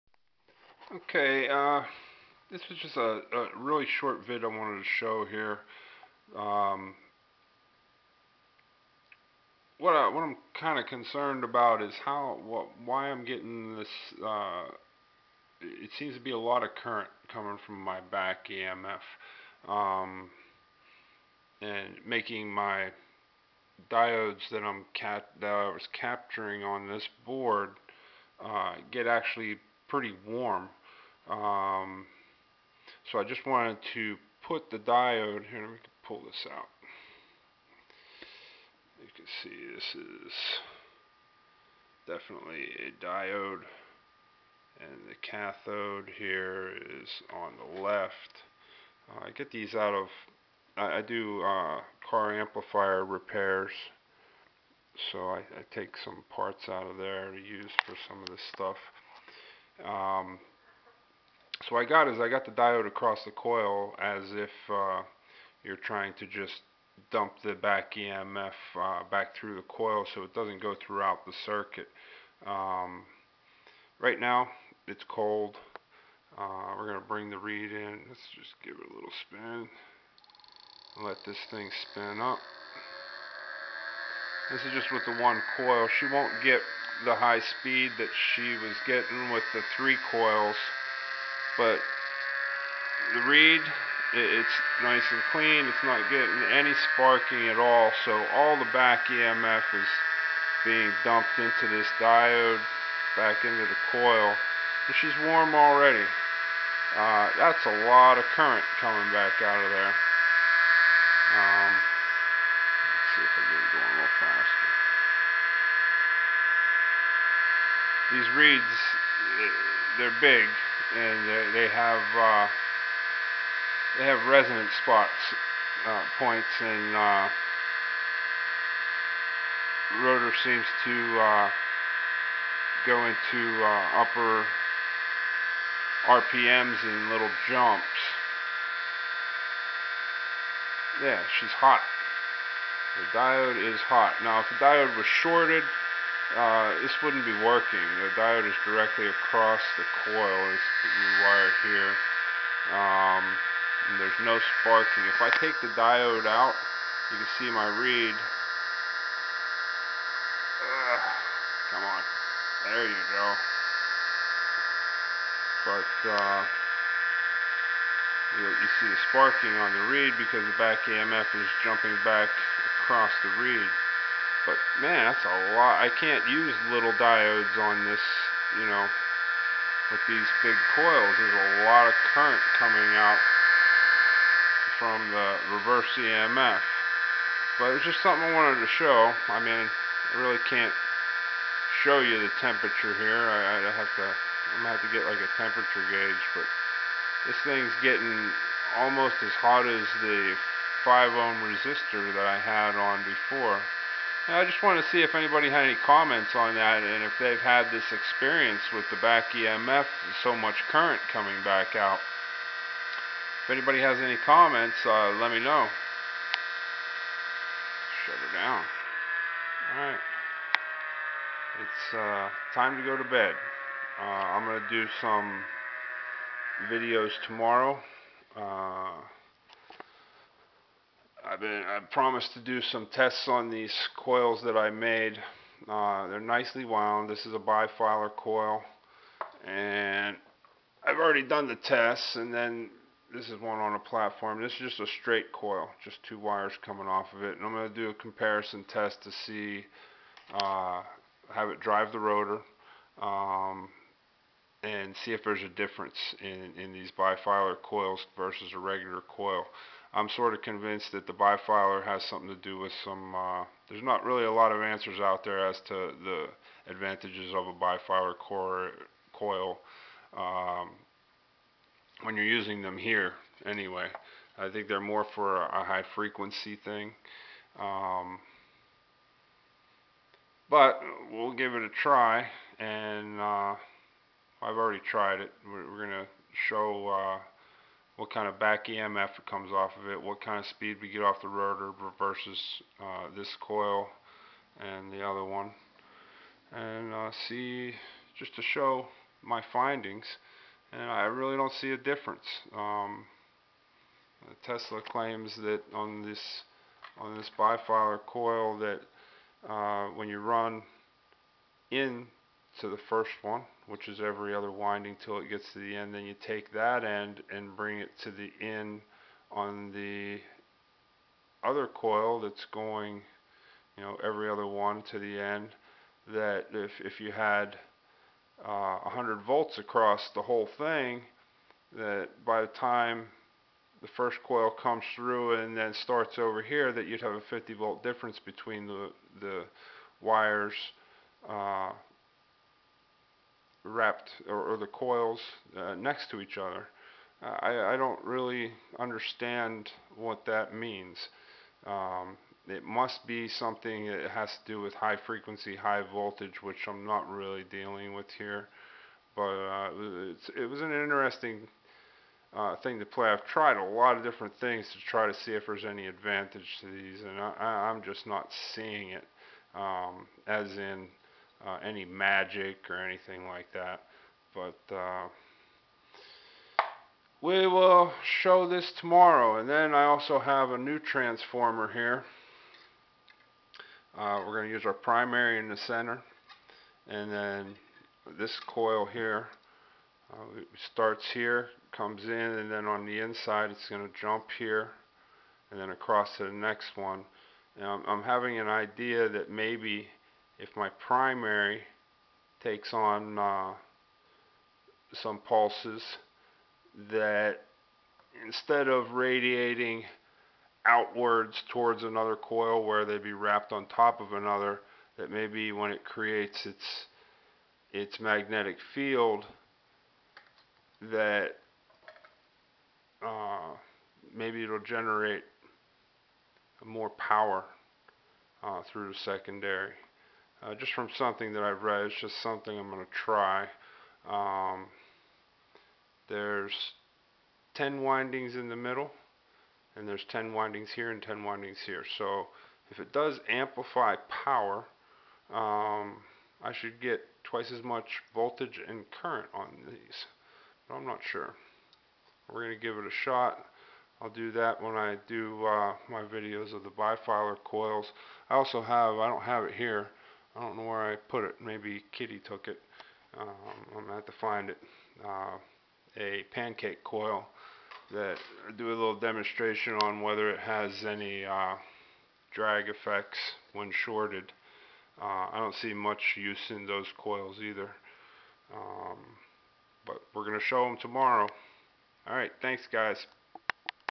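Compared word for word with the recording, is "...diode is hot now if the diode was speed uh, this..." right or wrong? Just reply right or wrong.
wrong.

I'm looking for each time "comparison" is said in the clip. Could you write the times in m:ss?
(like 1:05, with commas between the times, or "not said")
4:07.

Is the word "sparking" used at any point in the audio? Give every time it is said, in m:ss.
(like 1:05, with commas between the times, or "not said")
1:36, 2:34, 2:49.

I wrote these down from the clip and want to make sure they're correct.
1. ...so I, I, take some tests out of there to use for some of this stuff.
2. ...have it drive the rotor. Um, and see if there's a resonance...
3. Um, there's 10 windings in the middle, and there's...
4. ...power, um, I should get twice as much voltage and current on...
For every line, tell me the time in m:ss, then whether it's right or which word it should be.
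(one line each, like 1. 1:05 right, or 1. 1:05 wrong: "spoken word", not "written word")
1. 0:55 wrong: "parts", not "tests"
2. 4:11 wrong: "difference", not "resonance"
3. 7:14 right
4. 7:24 right.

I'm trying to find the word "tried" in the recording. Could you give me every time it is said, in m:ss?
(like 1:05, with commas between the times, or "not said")
4:44, 6:03.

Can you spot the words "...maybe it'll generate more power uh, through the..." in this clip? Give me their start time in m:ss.
7:04.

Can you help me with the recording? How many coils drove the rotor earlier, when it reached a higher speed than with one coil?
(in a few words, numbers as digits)
3.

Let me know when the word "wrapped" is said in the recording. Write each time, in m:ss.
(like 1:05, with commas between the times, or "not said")
5:43, 6:53.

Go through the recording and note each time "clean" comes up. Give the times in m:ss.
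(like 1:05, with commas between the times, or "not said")
1:35.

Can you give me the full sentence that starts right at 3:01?
There's a lot of current coming out from the reverse EMF.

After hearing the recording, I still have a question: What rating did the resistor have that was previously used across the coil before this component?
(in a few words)
5 ohm.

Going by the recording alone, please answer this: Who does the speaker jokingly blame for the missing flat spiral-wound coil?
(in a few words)
Kitty.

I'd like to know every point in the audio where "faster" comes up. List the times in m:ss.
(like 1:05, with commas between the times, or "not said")
1:54.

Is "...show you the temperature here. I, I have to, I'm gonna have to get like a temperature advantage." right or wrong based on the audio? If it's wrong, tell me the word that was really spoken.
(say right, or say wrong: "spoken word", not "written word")
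wrong: "gauge", not "advantage".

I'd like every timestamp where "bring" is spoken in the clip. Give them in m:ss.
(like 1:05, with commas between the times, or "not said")
1:17, 5:17.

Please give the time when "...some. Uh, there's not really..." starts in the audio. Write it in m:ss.
4:22.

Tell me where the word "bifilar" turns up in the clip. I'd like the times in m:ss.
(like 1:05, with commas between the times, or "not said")
3:57, 4:16, 4:21, 4:27, 5:07, 7:36.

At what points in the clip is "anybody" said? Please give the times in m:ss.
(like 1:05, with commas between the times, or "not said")
3:25, 3:33.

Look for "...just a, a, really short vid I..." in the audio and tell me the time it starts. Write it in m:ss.
0:02.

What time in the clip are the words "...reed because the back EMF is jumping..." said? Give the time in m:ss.
2:49.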